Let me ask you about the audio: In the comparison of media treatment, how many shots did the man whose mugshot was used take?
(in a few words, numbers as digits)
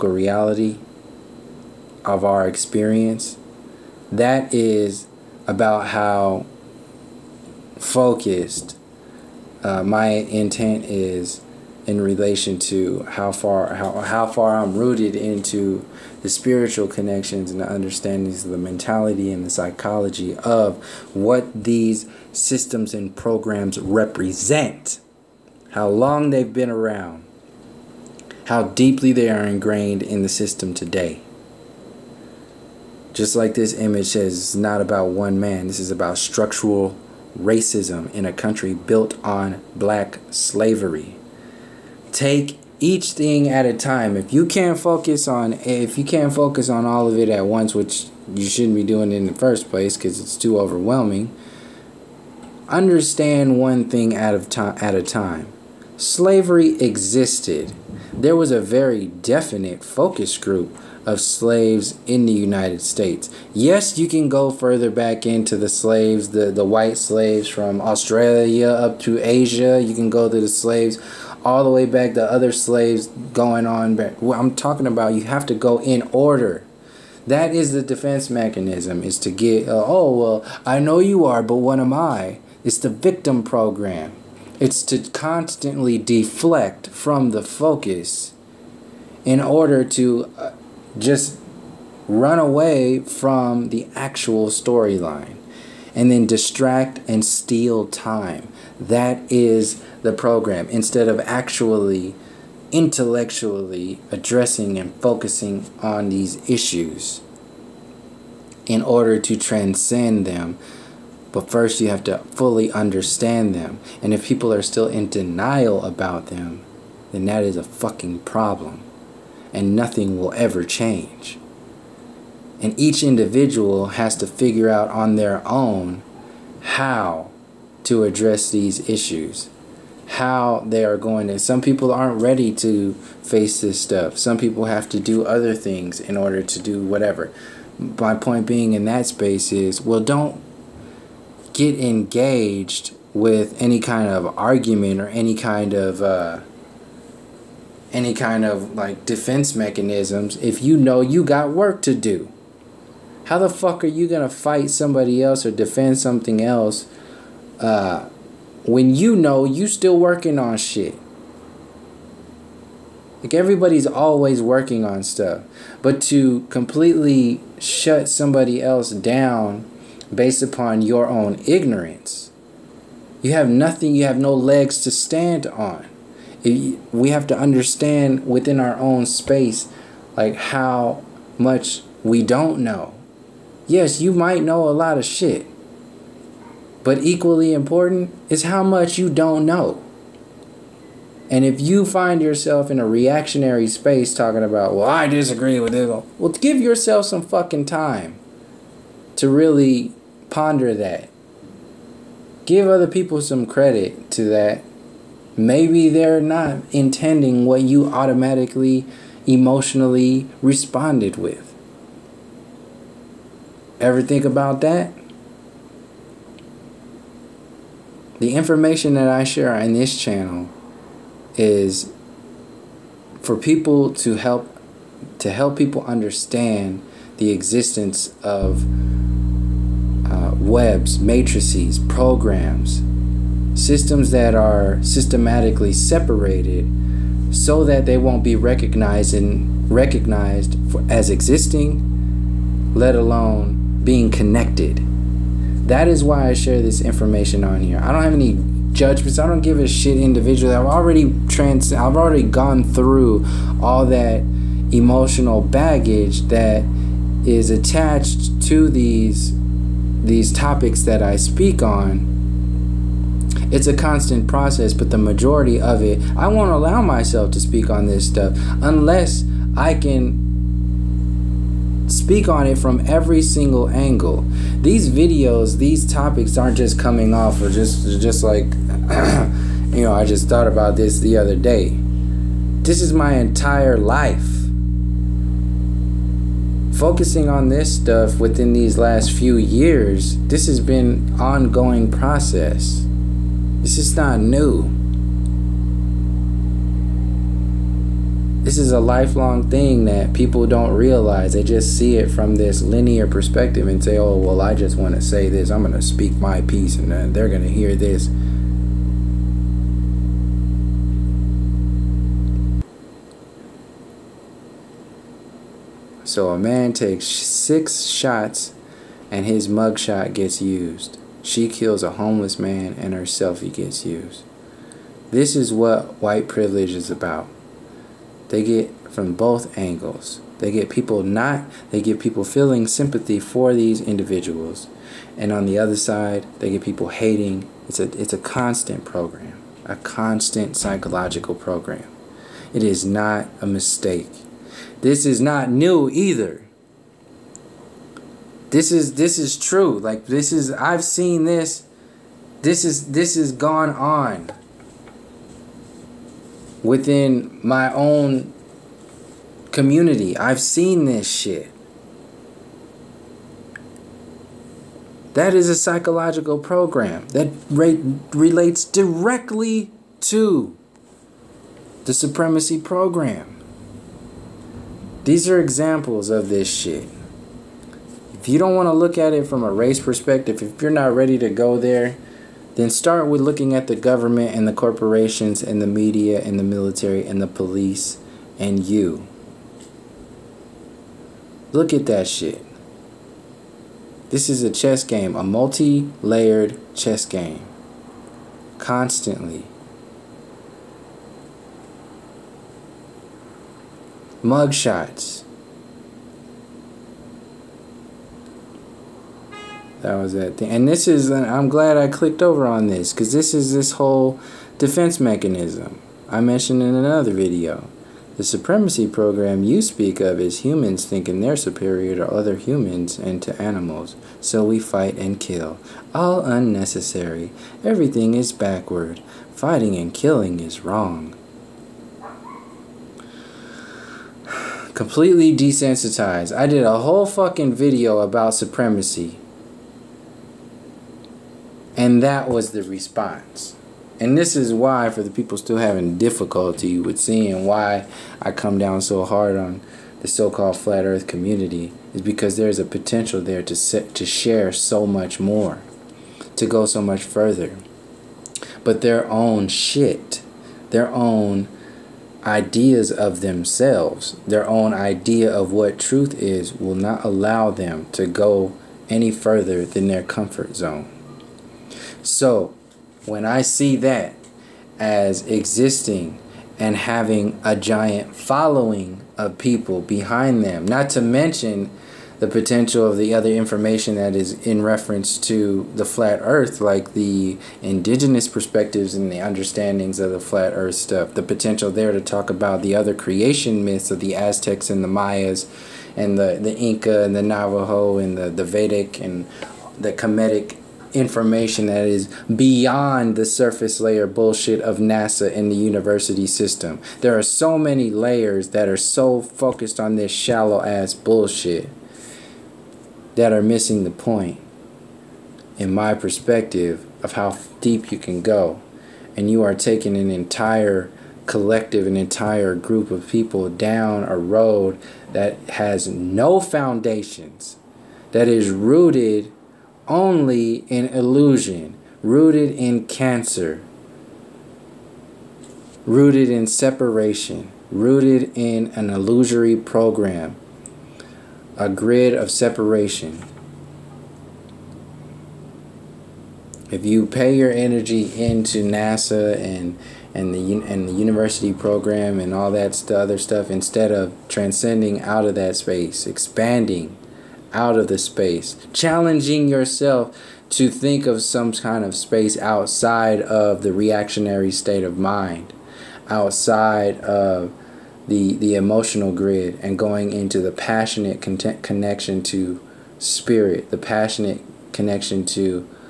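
6.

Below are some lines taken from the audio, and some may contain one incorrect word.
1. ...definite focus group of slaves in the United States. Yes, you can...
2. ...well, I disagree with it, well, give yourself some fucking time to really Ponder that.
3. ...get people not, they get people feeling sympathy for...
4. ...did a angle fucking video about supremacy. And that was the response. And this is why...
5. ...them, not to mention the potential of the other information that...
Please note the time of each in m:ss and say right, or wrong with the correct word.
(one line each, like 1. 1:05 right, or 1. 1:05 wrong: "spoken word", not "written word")
1. 0:59 right
2. 3:14 right
3. 5:30 right
4. 7:16 wrong: "whole", not "angle"
5. 8:00 right.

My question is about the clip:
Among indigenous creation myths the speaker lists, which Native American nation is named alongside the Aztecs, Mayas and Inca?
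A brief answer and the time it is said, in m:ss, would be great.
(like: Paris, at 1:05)
Navajo, at 8:17.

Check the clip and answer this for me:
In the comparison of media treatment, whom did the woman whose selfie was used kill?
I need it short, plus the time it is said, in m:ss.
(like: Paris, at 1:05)
a homeless man, at 5:21.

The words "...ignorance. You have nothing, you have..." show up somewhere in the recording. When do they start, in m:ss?
2:51.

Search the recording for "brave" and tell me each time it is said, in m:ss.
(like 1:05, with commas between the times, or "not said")
not said.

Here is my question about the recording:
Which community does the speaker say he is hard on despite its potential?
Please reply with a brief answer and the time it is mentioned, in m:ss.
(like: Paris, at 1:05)
flat earth community, at 7:30.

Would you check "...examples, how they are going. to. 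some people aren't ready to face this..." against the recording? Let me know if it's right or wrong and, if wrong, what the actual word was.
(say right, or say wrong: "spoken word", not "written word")
wrong: "issues", not "examples".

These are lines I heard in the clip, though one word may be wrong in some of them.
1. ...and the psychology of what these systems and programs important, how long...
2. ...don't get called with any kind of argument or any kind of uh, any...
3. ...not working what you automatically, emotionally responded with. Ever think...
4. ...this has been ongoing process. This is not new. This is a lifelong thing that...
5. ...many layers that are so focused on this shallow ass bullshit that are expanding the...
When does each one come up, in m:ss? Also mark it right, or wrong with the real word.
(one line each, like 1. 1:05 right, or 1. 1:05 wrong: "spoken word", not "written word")
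1. 0:19 wrong: "represent", not "important"
2. 2:19 wrong: "engaged", not "called"
3. 3:26 wrong: "intending", not "working"
4. 4:50 right
5. 8:27 wrong: "missing", not "expanding".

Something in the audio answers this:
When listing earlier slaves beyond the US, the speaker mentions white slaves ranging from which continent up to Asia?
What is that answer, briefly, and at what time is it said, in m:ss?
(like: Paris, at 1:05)
Australia, at 1:07.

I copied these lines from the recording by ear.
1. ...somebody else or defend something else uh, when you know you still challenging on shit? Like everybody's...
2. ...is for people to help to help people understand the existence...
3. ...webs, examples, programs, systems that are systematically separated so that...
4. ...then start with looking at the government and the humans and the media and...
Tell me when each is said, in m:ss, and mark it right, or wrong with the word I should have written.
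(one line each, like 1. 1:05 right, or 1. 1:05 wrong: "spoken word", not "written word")
1. 2:34 wrong: "working", not "challenging"
2. 3:41 right
3. 3:50 wrong: "matrices", not "examples"
4. 6:22 wrong: "corporations", not "humans".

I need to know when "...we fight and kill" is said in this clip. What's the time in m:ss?
7:04.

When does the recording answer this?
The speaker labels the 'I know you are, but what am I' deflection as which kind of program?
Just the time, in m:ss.
1:22.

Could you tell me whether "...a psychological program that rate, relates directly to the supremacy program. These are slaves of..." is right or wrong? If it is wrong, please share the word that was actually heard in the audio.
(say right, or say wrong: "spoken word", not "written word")
wrong: "examples", not "slaves".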